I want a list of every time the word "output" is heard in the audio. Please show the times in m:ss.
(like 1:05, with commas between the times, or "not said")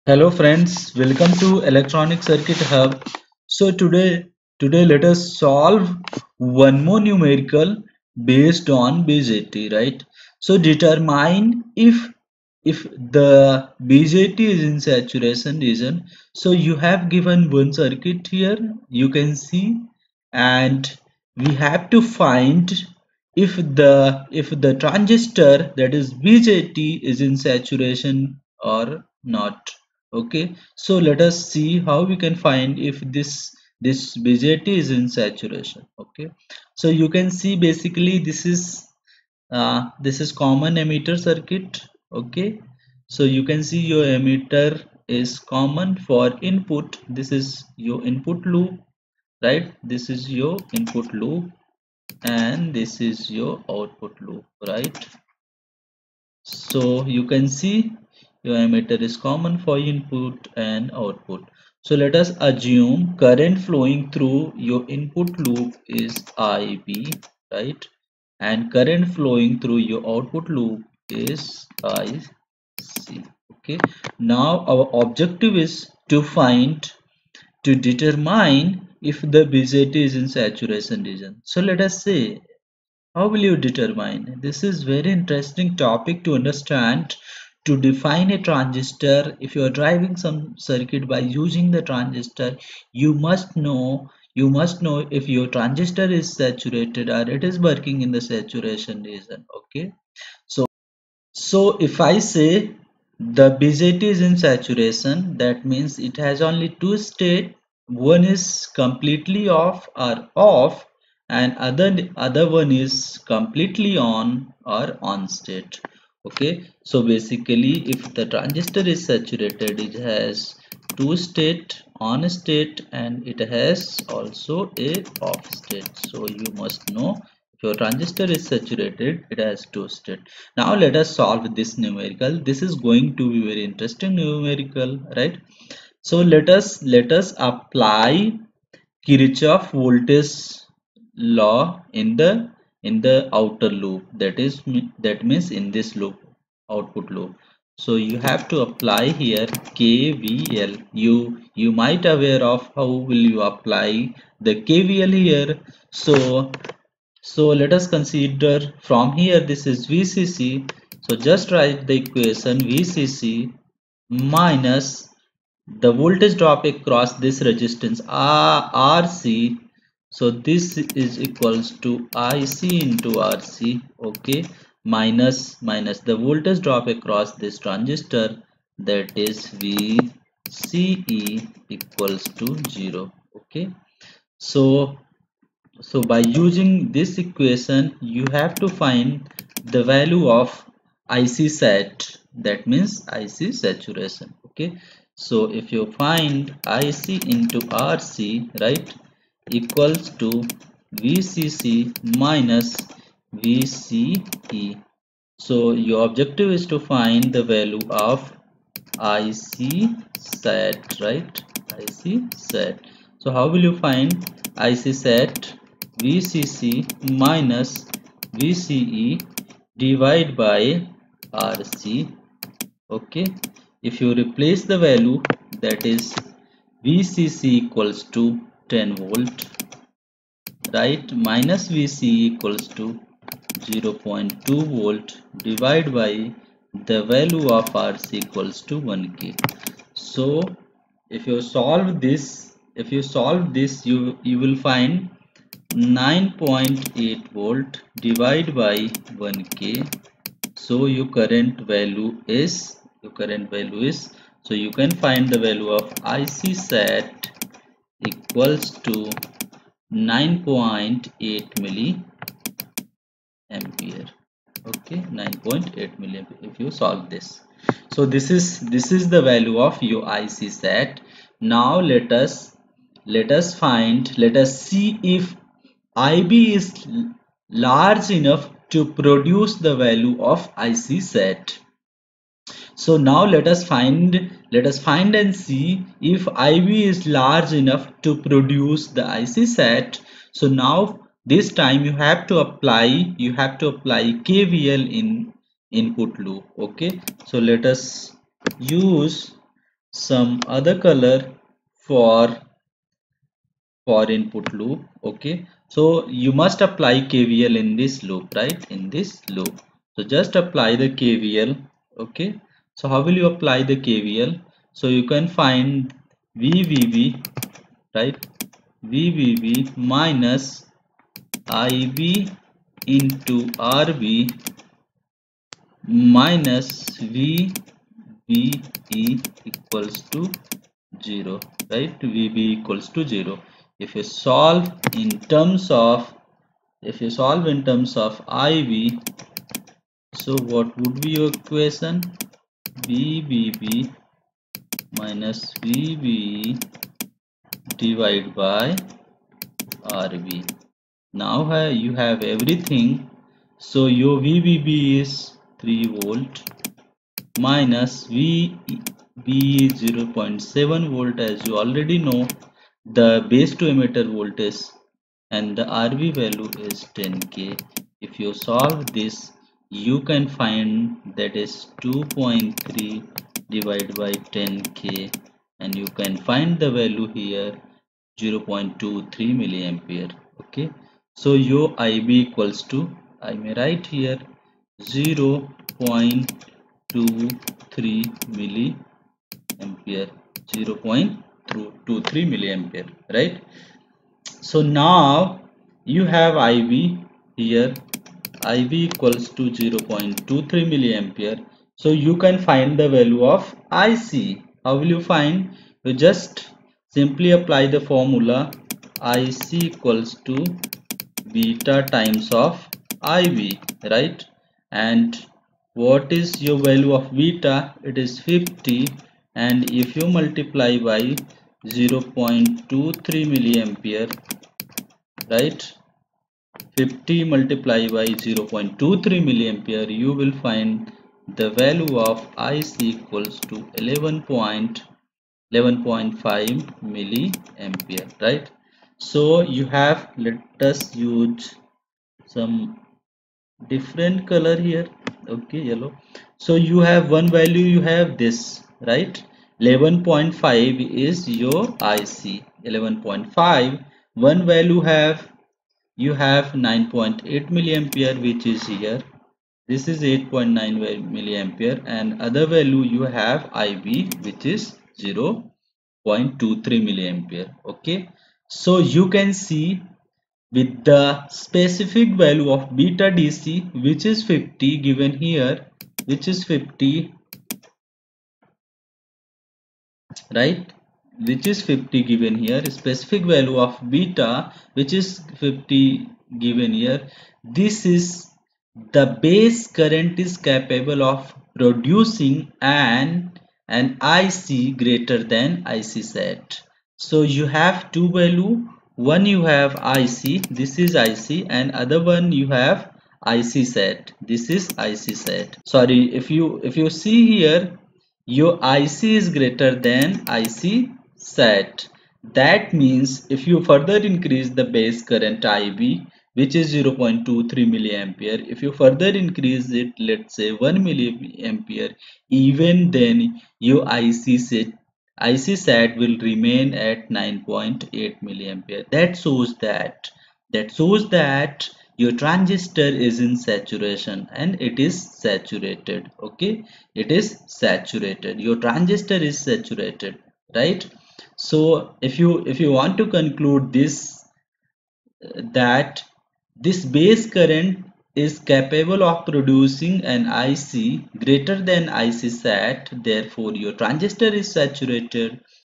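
0:53, 1:00, 1:10, 2:26.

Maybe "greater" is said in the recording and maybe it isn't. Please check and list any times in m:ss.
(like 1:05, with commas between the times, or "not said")
8:14, 8:29, 9:11.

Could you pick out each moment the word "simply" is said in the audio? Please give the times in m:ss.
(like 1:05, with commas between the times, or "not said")
6:46.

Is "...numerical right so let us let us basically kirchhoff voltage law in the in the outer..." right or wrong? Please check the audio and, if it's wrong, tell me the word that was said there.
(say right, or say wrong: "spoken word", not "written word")
wrong: "apply", not "basically".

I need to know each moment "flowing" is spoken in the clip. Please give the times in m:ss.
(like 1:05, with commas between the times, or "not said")
1:03, 1:09.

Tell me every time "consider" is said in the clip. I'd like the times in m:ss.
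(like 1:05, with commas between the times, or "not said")
2:37.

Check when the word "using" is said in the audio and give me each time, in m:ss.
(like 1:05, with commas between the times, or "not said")
1:31, 3:06.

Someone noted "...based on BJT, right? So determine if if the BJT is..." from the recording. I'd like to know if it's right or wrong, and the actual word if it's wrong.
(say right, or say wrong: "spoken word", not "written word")
right.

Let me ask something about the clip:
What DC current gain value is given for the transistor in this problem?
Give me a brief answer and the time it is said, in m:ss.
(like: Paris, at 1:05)
50, at 6:57.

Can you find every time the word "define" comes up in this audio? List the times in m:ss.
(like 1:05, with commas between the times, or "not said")
1:27.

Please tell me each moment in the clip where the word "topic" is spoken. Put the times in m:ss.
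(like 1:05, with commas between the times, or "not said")
1:25.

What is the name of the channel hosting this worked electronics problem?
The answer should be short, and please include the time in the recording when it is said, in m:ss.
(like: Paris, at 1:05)
Electronic Circuit Hub, at 0:01.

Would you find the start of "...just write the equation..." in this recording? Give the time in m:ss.
2:41.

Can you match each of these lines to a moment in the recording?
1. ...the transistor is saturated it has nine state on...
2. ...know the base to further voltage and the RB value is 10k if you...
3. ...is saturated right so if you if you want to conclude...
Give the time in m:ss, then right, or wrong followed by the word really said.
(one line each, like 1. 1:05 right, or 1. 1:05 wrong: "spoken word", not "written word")
1. 1:58 wrong: "two", not "nine"
2. 6:01 wrong: "emitter", not "further"
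3. 8:59 right.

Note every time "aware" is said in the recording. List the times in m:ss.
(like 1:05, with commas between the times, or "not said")
2:32.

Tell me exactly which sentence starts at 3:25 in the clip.
So your objective is to find the value of IC set, right?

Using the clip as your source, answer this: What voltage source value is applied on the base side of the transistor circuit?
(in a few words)
3 volts.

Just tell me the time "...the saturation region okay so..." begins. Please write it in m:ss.
1:38.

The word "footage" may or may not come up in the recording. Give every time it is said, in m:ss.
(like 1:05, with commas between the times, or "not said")
not said.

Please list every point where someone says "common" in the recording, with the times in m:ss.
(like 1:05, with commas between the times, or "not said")
0:40, 0:45, 0:59.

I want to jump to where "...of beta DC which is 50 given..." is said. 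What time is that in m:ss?
7:52.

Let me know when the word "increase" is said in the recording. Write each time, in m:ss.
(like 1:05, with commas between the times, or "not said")
8:34, 8:39.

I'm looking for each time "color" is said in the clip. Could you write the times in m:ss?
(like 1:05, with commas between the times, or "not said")
5:00, 7:24.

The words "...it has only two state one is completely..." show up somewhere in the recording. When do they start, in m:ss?
1:45.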